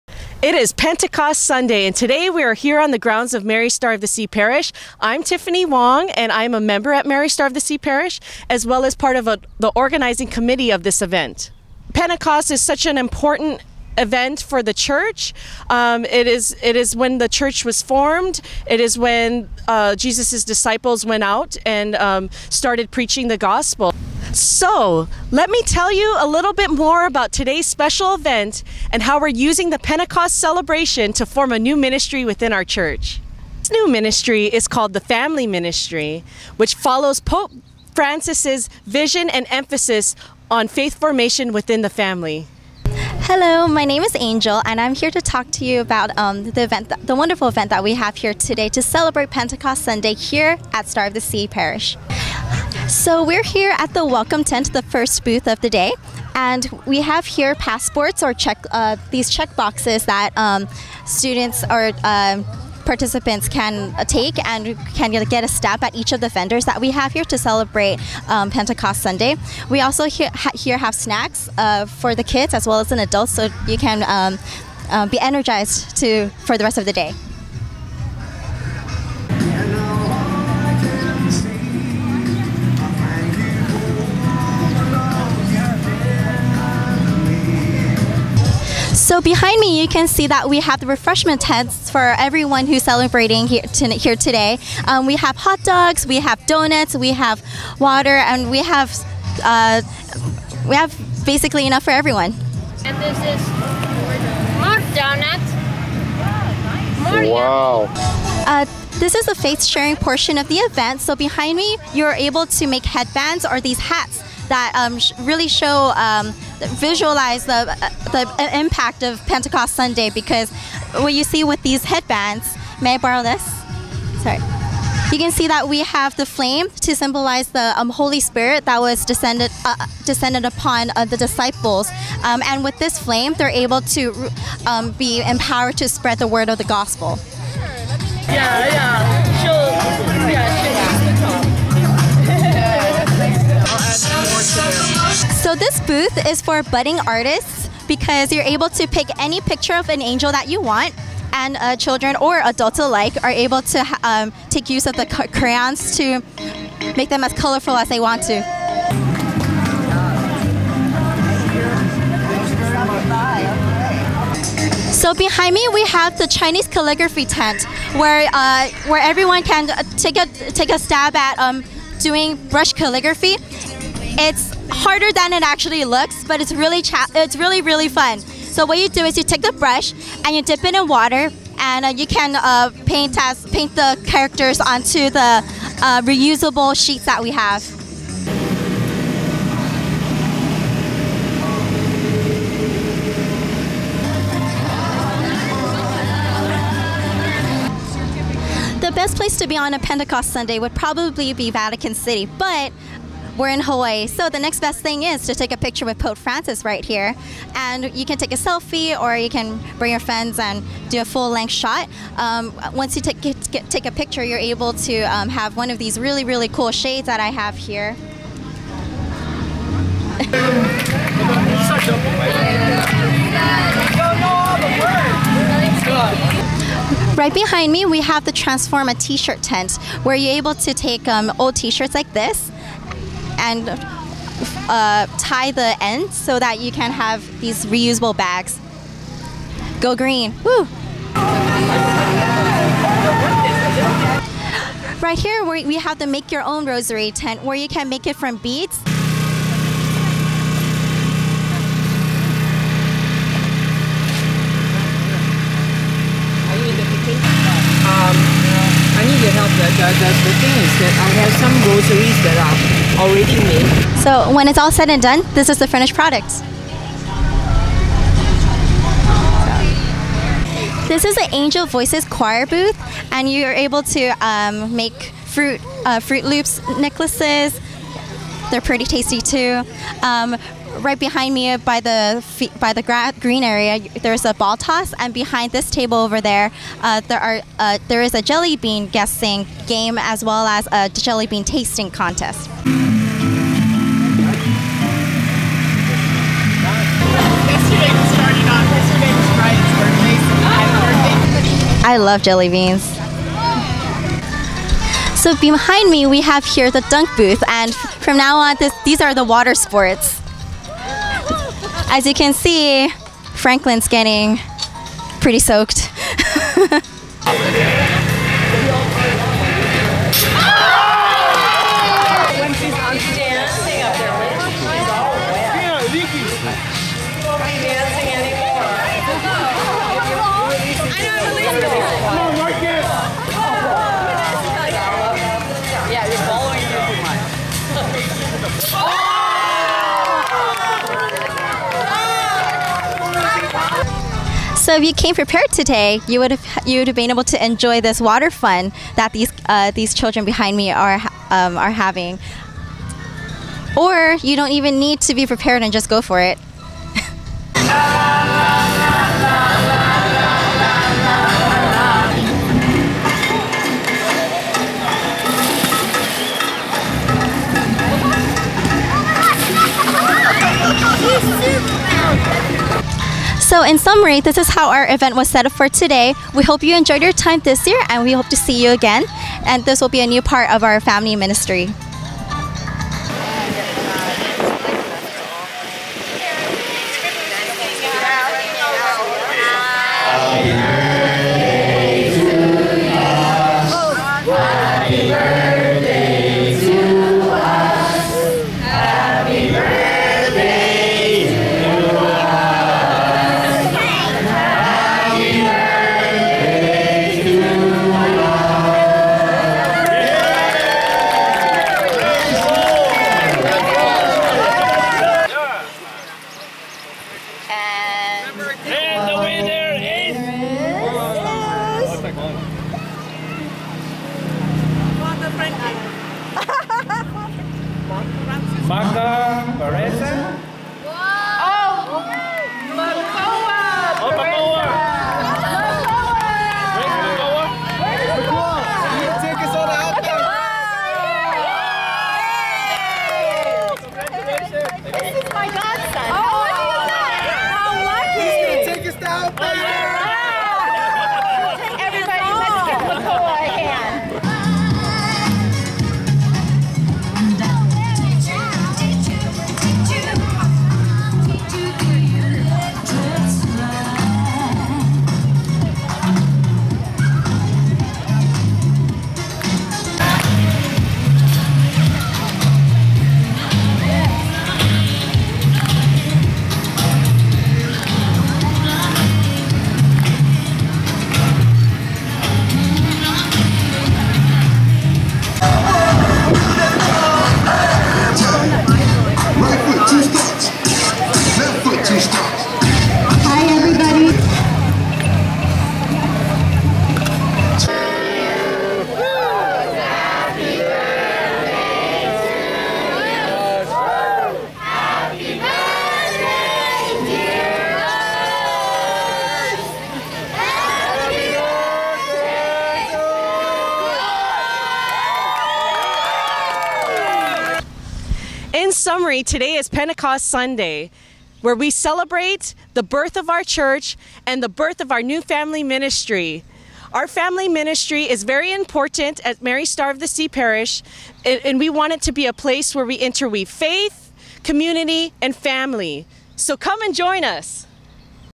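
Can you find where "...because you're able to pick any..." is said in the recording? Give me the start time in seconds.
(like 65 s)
147 s.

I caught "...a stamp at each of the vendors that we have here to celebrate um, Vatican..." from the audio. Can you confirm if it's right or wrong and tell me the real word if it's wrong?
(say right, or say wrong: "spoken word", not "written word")
wrong: "Pentecost", not "Vatican".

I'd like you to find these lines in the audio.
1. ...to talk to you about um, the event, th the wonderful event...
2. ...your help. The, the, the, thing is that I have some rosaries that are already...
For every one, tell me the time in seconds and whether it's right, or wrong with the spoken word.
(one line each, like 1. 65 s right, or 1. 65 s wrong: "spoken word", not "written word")
1. 45 s right
2. 259 s right.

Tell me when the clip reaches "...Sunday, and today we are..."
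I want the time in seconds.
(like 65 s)
1 s.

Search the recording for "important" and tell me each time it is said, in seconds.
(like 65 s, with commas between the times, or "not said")
12 s, 528 s.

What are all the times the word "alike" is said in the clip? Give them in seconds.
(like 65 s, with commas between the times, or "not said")
152 s.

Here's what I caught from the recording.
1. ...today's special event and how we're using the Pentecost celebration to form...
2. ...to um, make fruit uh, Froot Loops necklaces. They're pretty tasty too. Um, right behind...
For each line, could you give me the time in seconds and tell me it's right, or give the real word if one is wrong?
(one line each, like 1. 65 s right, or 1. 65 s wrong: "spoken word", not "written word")
1. 27 s right
2. 273 s right.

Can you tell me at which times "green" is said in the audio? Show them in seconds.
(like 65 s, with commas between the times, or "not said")
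239 s, 283 s.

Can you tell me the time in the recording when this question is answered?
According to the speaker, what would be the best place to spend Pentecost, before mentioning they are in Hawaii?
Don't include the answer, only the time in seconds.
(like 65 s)
201 s.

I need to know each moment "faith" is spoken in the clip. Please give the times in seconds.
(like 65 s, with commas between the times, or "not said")
40 s, 533 s.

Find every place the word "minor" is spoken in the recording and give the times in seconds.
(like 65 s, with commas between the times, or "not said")
not said.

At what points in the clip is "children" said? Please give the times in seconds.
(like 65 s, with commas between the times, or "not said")
151 s, 349 s.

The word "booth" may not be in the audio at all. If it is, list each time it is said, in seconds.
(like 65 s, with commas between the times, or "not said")
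55 s, 145 s, 272 s, 307 s.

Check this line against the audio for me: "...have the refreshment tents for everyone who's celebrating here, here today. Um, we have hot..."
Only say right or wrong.
right.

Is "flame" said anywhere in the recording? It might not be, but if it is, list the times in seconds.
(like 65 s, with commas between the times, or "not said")
126 s, 132 s.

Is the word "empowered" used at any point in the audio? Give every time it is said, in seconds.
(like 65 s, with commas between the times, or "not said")
135 s.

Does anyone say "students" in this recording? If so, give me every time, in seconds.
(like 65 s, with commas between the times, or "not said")
61 s.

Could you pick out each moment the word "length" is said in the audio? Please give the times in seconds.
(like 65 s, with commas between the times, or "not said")
211 s.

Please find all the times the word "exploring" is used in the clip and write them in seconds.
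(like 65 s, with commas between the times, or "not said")
not said.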